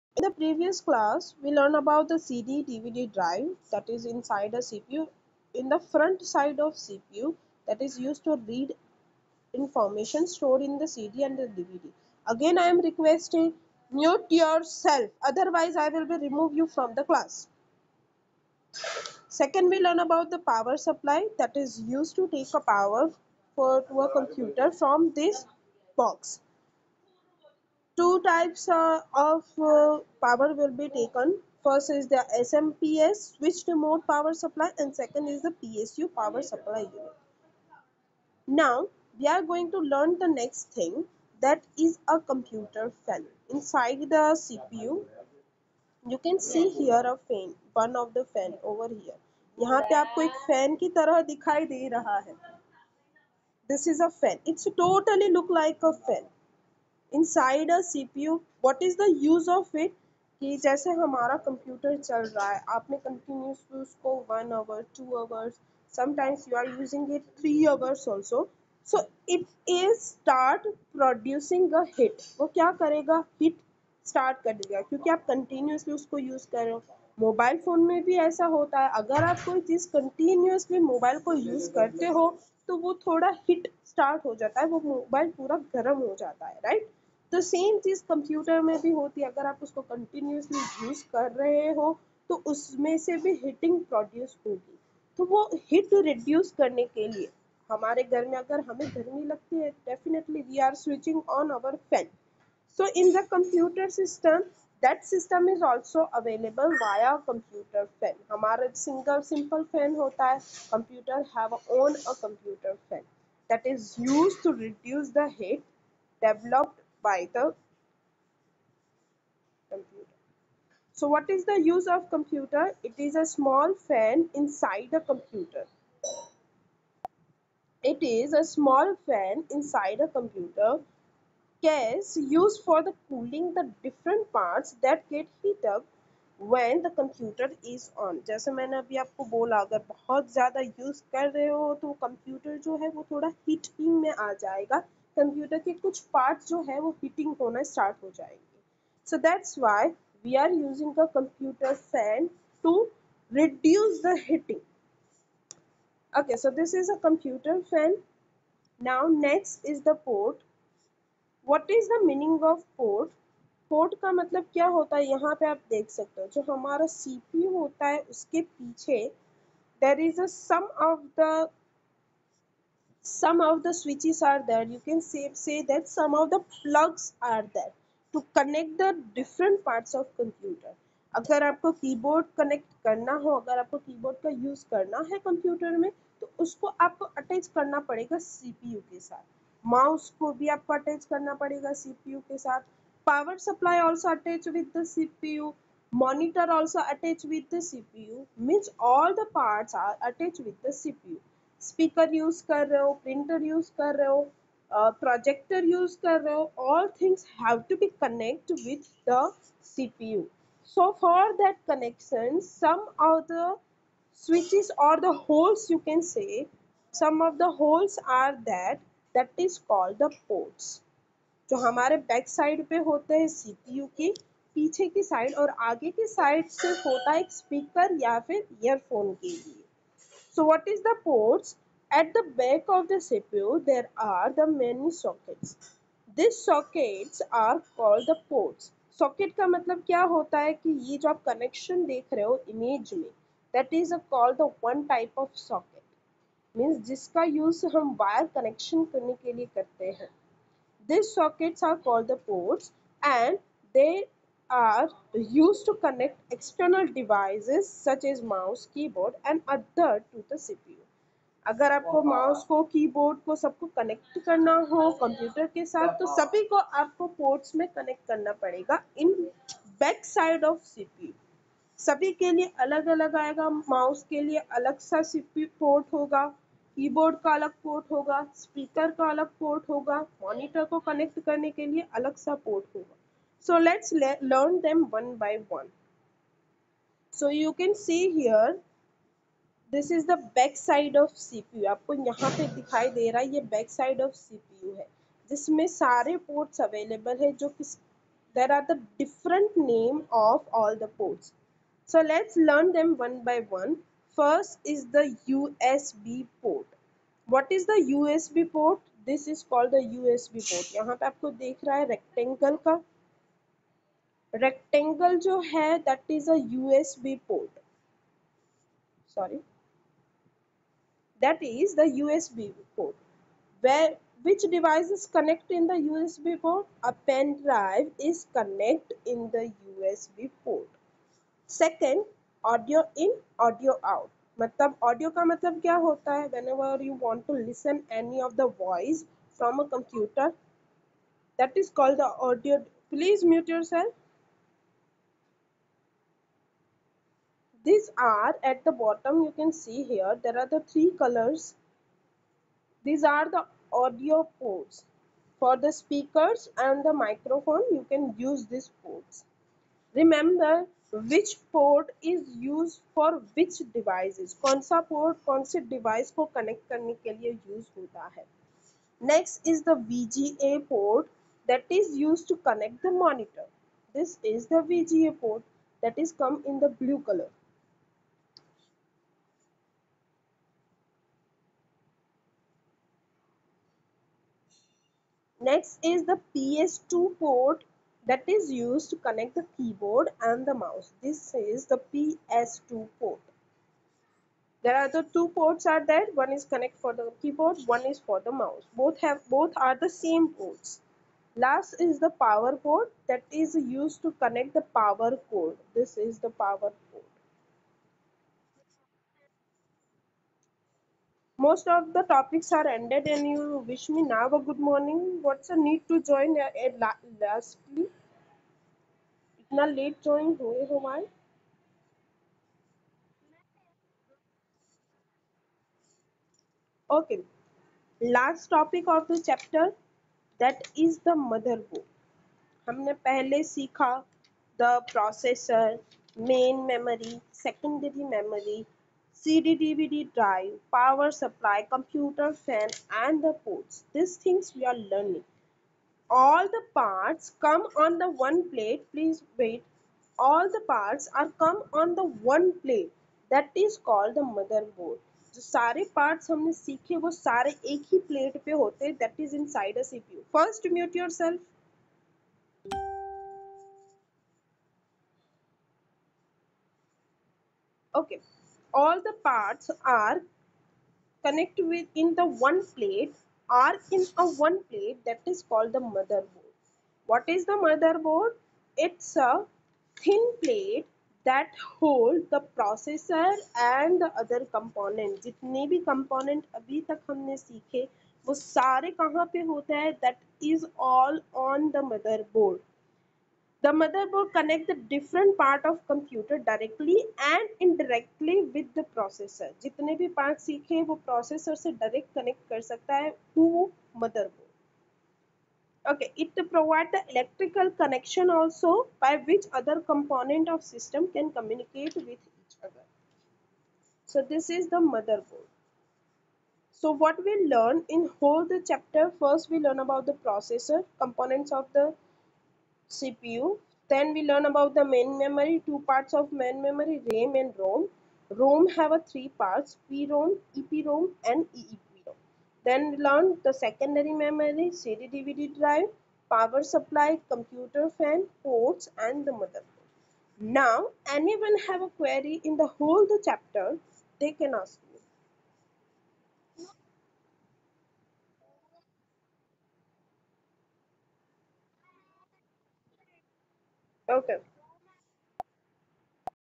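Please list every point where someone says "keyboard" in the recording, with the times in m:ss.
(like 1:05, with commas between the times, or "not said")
4:18, 6:29, 6:37.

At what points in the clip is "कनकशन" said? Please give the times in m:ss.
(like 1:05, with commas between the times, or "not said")
3:31, 4:01, 4:08.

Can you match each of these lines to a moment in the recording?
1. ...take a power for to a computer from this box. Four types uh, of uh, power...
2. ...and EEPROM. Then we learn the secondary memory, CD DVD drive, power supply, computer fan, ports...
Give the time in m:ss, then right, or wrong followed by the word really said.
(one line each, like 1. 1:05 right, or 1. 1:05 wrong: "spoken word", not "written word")
1. 0:22 wrong: "Two", not "Four"
2. 8:51 right.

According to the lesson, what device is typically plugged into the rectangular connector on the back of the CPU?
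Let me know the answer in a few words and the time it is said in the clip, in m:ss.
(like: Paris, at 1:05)
pen drive, at 5:27.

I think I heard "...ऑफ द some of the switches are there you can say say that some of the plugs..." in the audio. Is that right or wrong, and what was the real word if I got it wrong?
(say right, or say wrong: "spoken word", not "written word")
right.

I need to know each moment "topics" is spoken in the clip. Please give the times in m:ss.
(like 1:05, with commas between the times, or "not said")
6:52, 7:08.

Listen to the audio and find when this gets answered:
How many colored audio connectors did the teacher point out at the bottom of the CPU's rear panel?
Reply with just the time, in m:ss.
5:50.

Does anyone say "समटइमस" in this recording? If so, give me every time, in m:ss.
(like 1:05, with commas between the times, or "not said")
1:05.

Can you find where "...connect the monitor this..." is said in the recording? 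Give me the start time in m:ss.
6:12.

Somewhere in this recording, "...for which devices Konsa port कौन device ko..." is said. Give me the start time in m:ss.
6:02.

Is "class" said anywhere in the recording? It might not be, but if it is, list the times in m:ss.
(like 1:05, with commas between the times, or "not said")
0:00, 0:17.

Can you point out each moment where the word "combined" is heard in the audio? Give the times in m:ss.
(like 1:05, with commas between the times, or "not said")
not said.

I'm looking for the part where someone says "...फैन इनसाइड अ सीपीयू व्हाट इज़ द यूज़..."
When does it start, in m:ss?
0:56.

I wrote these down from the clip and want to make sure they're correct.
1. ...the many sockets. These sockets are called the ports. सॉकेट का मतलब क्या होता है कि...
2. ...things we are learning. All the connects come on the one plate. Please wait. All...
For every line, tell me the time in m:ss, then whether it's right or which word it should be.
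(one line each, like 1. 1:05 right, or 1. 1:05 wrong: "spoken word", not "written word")
1. 3:54 right
2. 7:24 wrong: "parts", not "connects".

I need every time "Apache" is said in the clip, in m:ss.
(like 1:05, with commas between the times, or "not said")
not said.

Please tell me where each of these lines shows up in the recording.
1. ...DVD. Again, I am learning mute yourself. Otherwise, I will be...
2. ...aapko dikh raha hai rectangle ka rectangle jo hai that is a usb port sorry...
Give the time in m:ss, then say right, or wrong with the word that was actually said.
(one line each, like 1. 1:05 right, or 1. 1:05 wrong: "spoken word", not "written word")
1. 0:11 wrong: "requesting", not "learning"
2. 5:11 right.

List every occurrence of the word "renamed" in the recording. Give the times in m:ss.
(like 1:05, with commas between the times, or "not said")
not said.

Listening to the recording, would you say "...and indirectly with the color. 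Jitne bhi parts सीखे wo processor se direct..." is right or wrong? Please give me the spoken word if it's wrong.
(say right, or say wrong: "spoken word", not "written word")
wrong: "processor", not "color".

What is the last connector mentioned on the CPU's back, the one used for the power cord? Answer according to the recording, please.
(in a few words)
power port.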